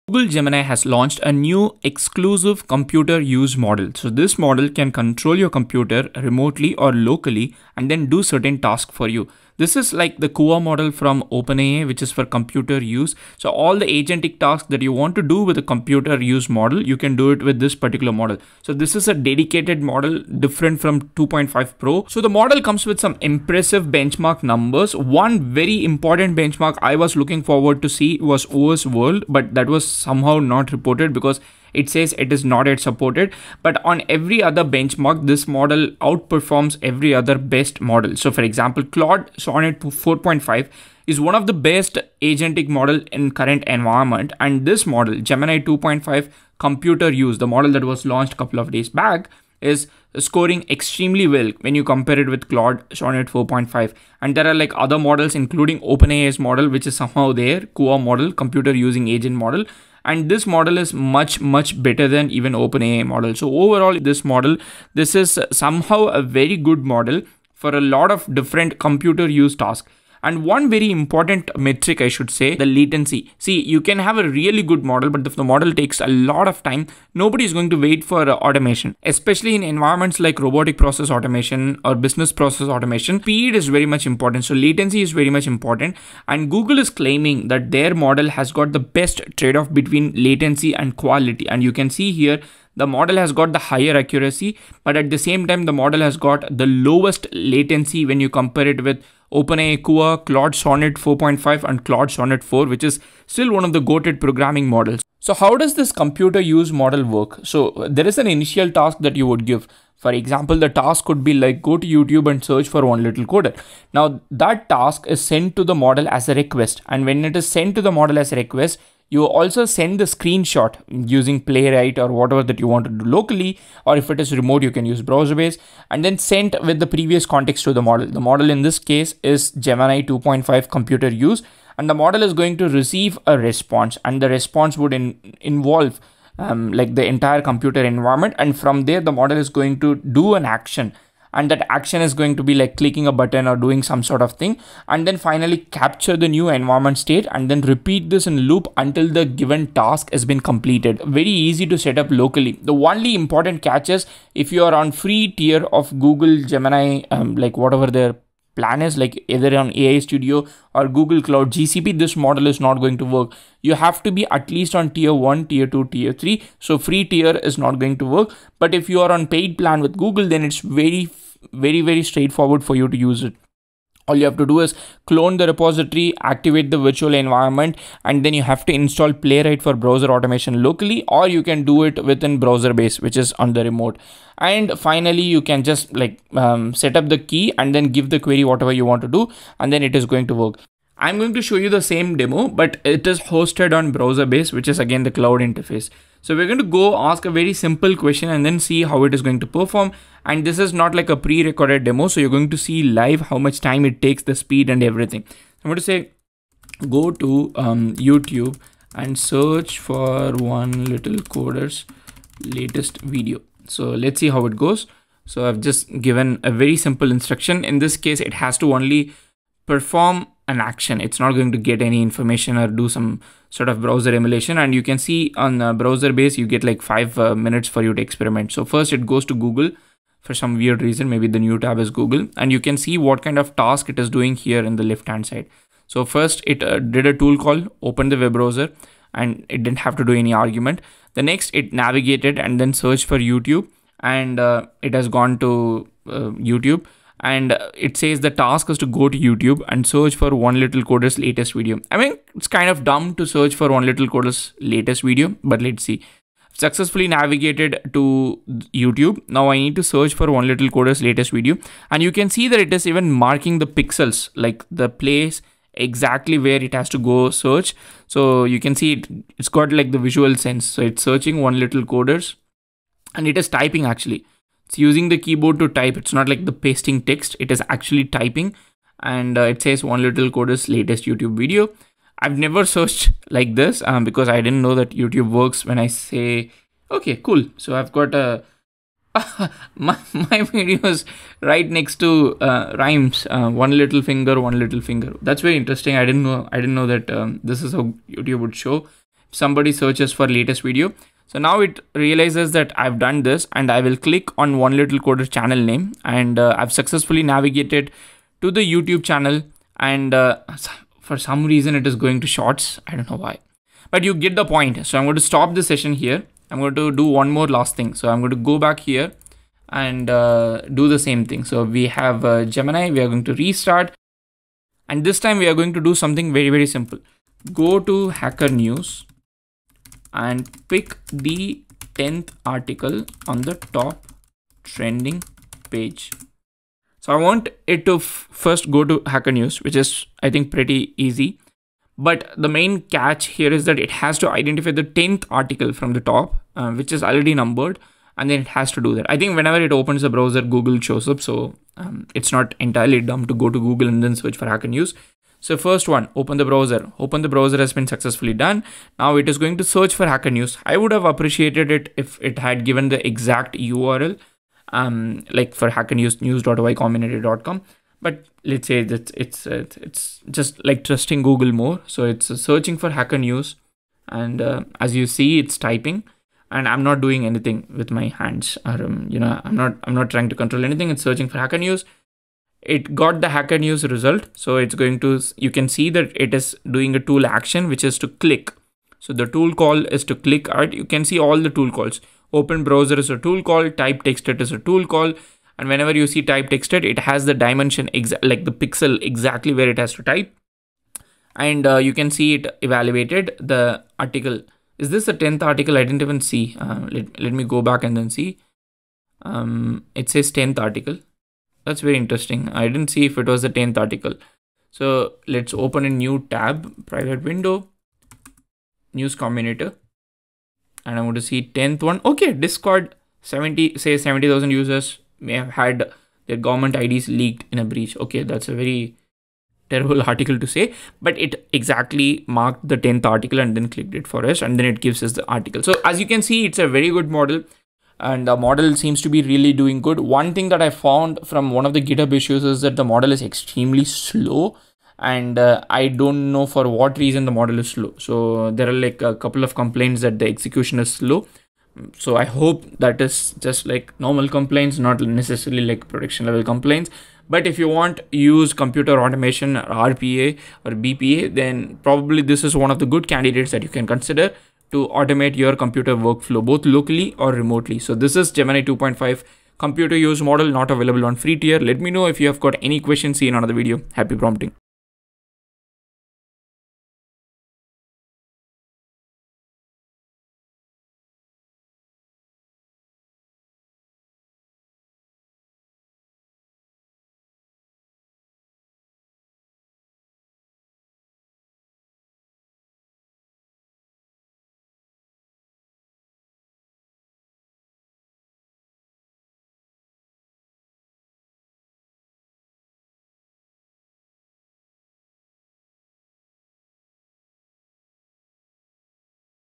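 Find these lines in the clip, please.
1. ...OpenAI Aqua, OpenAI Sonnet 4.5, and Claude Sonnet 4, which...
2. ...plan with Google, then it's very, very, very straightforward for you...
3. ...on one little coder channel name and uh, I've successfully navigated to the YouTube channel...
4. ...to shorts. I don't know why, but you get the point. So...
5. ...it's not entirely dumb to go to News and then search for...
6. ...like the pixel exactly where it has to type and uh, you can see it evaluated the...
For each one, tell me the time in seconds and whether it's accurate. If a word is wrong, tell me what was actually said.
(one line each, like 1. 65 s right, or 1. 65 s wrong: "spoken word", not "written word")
1. 99 s wrong: "Claude", not "OpenAI"
2. 169 s right
3. 304 s right
4. 312 s right
5. 352 s wrong: "Google", not "News"
6. 398 s right.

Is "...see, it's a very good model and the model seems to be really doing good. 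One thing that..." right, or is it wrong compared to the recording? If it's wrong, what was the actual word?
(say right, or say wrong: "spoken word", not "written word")
right.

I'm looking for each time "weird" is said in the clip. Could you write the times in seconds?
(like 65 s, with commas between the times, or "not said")
230 s.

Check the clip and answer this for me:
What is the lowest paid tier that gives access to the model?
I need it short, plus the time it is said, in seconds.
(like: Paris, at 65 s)
Tier 1, at 164 s.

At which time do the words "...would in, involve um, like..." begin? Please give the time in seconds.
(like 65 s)
134 s.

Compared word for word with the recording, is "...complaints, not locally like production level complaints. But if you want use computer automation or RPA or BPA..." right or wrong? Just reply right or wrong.
wrong.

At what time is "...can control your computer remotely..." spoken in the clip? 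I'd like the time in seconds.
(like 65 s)
4 s.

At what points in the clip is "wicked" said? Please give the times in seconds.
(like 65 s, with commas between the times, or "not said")
not said.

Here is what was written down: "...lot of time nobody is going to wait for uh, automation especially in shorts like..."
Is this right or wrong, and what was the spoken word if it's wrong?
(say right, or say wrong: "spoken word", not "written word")
wrong: "environments", not "shorts".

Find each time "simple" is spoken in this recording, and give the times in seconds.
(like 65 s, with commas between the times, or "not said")
197 s, 216 s, 326 s.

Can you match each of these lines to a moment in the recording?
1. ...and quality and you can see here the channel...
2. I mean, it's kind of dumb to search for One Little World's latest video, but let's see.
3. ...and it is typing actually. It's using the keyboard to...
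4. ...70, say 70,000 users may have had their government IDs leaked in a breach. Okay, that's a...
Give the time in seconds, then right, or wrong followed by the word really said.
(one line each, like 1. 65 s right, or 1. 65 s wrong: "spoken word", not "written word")
1. 90 s wrong: "model", not "channel"
2. 251 s wrong: "Coder", not "World"
3. 273 s right
4. 423 s right.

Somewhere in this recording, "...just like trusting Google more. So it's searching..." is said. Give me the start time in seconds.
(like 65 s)
370 s.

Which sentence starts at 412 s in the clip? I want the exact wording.
I didn't see if it was the 10th article.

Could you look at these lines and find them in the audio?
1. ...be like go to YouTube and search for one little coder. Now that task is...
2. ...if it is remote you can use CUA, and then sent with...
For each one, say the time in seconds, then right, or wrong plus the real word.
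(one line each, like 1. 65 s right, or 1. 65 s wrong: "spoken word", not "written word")
1. 111 s right
2. 123 s wrong: "BrowserBase", not "CUA".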